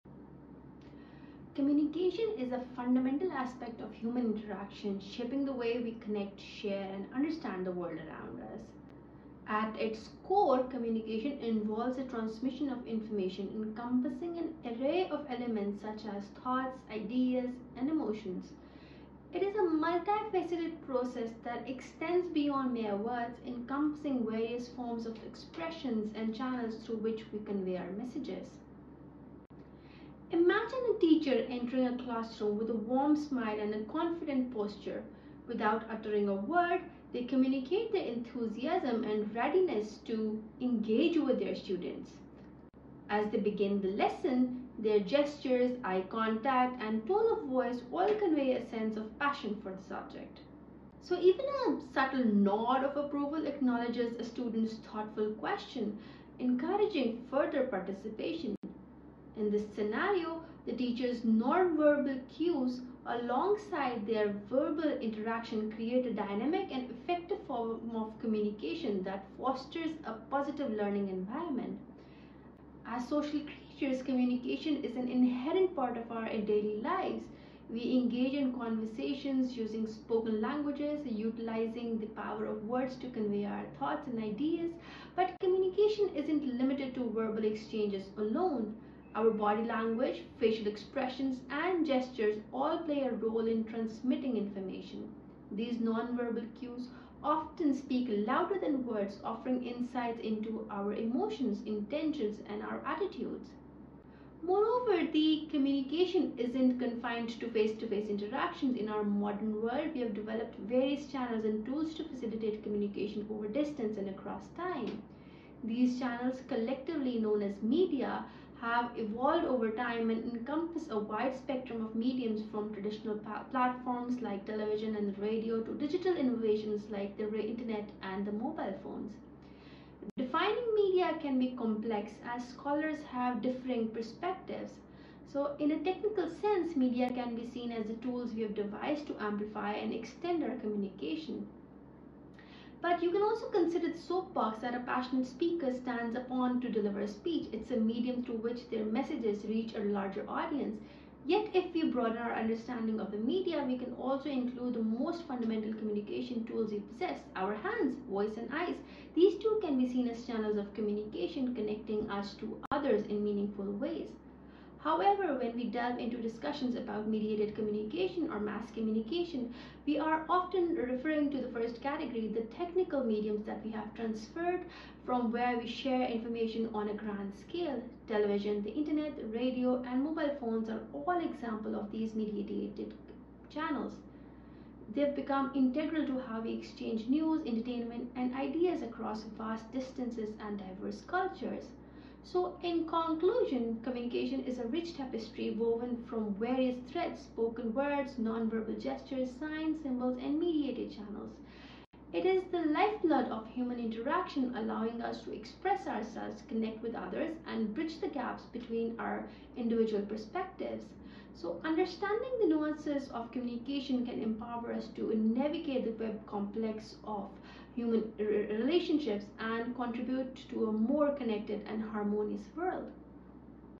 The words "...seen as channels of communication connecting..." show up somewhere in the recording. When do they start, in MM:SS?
02:39.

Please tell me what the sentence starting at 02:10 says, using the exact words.
Defining media can be complex as scholars have differing perspectives.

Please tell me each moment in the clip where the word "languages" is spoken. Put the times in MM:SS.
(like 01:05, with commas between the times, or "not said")
01:20, 01:29.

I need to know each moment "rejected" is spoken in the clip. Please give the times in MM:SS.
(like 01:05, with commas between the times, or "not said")
not said.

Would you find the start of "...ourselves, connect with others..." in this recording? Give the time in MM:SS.
03:25.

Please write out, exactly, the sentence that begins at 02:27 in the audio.
It's a medium through which their messages reach a larger audience.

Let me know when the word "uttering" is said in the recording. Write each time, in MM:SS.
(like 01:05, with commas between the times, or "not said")
00:35.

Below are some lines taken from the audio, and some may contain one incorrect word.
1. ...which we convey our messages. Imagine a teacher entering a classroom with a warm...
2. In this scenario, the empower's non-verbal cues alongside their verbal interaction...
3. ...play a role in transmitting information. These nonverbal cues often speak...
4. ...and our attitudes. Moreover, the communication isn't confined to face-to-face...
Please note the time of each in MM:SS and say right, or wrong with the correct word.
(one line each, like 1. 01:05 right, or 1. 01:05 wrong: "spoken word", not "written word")
1. 00:26 right
2. 00:59 wrong: "teacher", not "empower"
3. 01:32 right
4. 01:42 right.